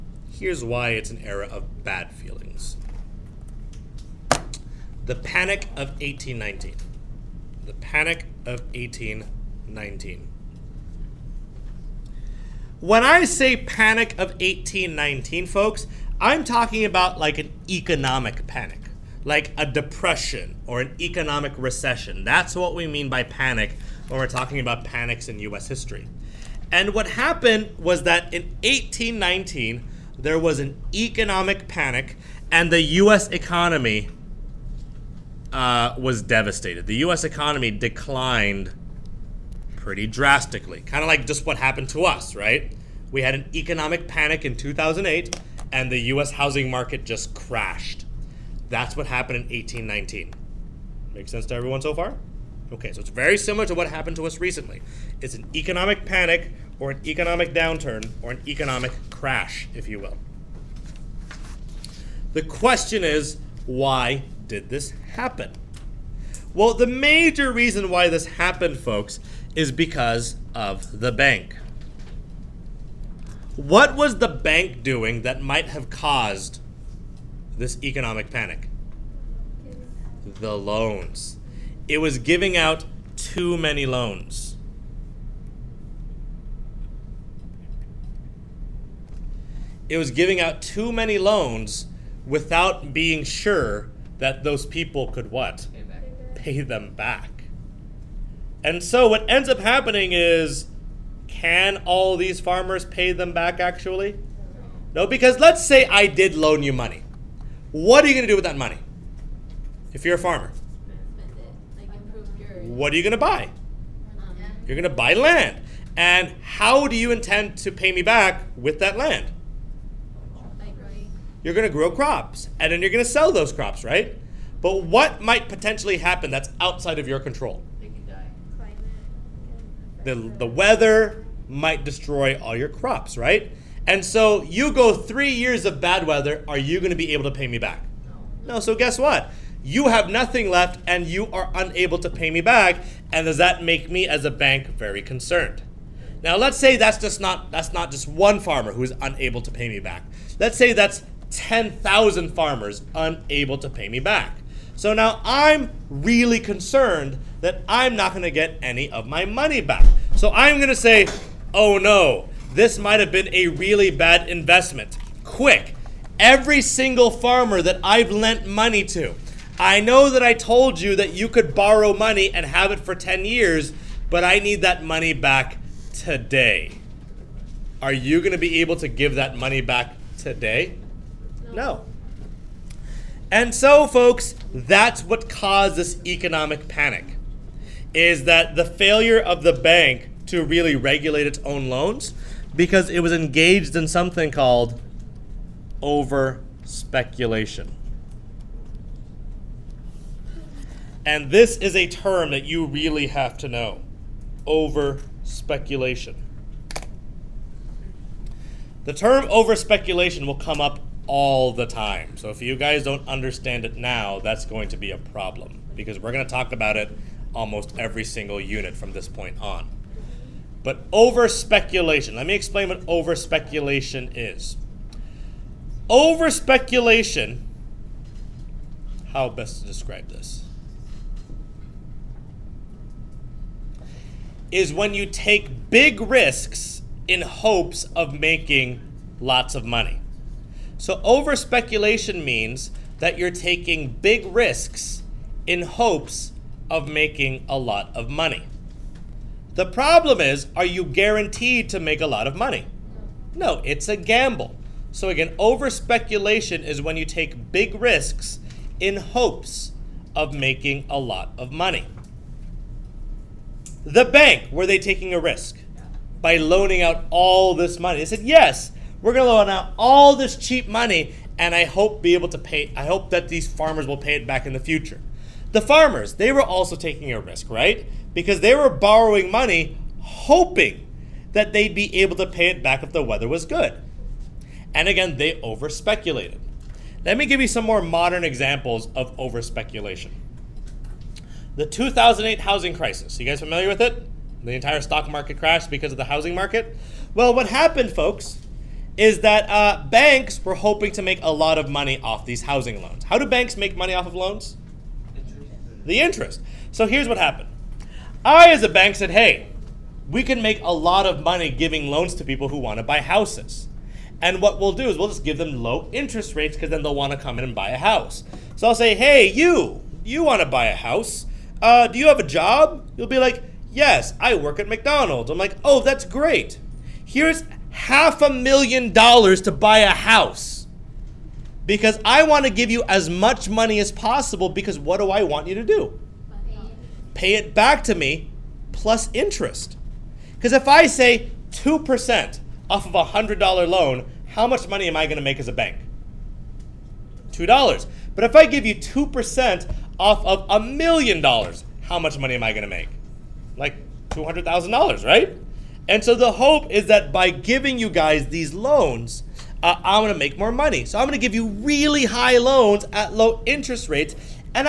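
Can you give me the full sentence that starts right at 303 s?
How do banks make money off of loans?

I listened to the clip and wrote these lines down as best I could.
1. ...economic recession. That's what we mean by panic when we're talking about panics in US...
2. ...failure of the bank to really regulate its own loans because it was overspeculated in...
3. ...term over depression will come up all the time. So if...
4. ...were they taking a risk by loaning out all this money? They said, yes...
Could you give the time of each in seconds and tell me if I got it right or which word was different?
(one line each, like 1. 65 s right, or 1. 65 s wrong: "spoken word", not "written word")
1. 20 s right
2. 188 s wrong: "engaged", not "overspeculated"
3. 208 s wrong: "speculation", not "depression"
4. 264 s right.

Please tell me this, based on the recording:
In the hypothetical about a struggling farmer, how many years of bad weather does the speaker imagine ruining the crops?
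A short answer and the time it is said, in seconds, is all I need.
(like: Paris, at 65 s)
3, at 134 s.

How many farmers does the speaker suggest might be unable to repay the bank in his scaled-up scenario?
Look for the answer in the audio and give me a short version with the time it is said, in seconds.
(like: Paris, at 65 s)
10,000, at 151 s.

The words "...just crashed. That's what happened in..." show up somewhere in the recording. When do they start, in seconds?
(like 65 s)
47 s.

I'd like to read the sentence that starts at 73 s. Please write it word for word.
What was the bank doing that might have caused this economic panic?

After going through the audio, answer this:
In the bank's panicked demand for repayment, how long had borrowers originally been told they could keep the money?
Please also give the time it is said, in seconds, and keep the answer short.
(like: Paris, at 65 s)
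10 years, at 172 s.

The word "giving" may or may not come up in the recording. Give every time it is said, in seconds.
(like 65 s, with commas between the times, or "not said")
82 s, 90 s, 311 s, 357 s.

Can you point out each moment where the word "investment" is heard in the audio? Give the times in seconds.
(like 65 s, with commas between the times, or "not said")
164 s.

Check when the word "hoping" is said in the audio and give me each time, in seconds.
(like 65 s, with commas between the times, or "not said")
280 s, 300 s.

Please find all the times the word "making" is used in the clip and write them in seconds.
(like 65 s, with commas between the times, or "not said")
238 s, 246 s, 260 s.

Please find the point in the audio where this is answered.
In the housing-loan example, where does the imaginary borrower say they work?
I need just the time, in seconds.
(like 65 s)
324 s.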